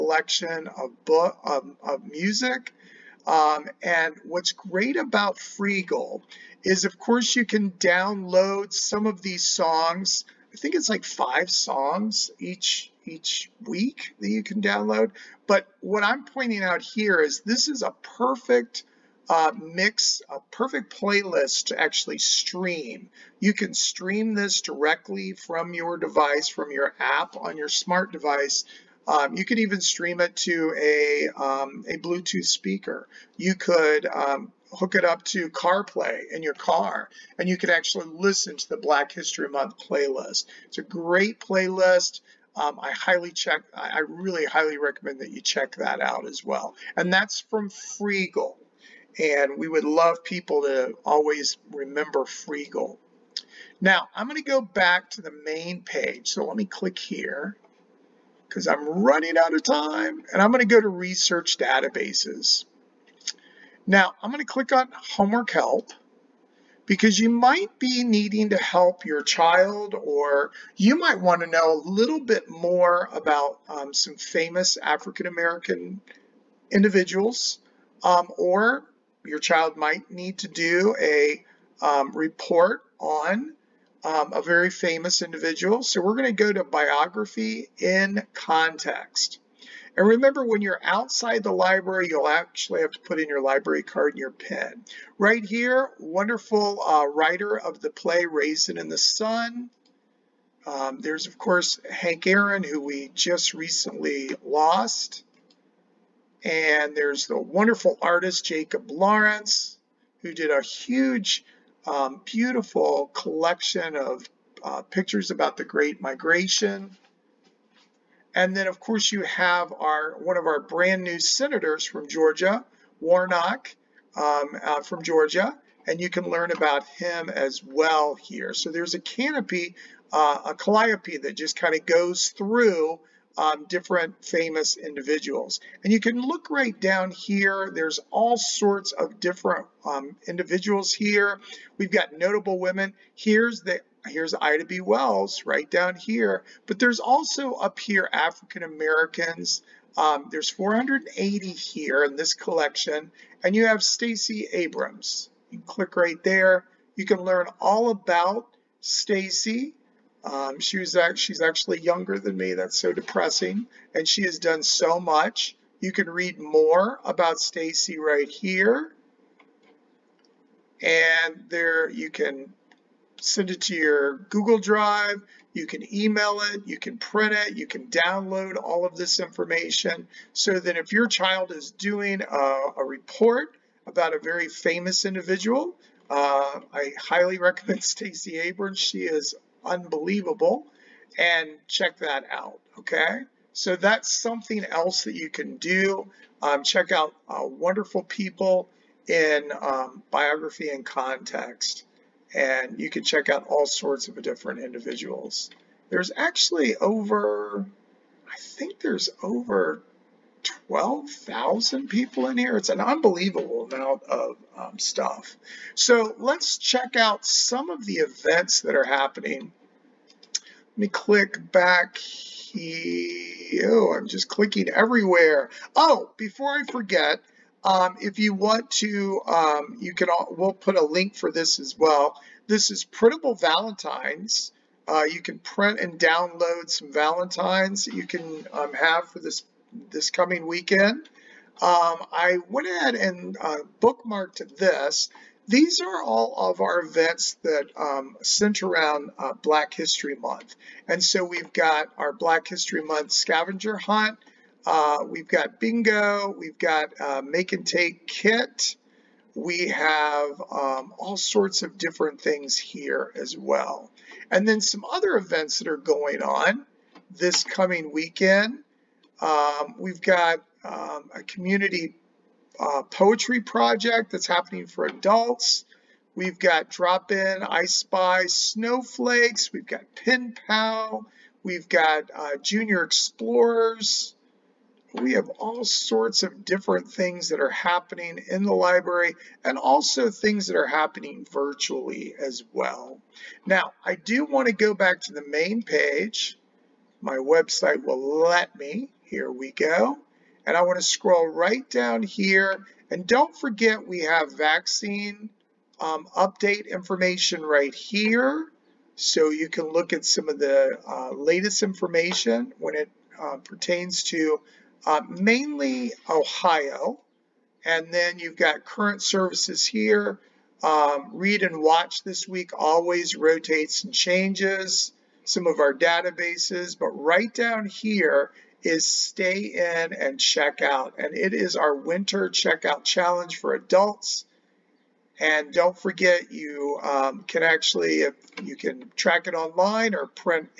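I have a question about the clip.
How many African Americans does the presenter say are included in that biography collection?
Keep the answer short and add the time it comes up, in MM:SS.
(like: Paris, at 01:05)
480, at 02:30.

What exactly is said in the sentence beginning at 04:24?
And then some other events that are going on this coming weekend.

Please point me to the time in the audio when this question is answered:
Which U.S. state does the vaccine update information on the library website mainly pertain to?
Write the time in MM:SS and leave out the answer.
05:16.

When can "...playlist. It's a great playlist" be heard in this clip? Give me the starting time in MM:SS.
00:39.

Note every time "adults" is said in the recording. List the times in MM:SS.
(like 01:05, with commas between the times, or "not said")
04:34, 05:33.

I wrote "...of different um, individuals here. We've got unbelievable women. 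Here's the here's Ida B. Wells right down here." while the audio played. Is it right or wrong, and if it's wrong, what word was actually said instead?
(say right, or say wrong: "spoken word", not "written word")
wrong: "notable", not "unbelievable".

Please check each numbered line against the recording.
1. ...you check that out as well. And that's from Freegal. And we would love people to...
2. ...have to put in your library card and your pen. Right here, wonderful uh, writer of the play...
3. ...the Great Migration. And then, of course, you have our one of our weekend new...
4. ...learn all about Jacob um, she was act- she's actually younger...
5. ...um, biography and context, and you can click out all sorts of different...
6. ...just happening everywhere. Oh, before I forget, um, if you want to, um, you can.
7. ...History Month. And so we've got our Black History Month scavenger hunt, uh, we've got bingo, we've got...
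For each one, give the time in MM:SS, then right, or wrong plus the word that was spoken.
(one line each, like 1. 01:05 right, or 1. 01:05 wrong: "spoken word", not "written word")
1. 00:45 right
2. 01:32 right
3. 01:55 wrong: "brand", not "weekend"
4. 02:37 wrong: "Stacey", not "Jacob"
5. 03:19 wrong: "check", not "click"
6. 03:44 wrong: "clicking", not "happening"
7. 04:09 right.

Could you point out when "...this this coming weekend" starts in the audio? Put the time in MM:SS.
03:59.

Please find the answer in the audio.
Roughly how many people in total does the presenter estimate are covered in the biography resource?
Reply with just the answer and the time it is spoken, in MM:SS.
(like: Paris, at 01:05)
12,000, at 03:30.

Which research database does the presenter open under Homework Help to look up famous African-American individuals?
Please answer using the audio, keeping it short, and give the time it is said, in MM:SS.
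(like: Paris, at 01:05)
Biography in Context, at 01:26.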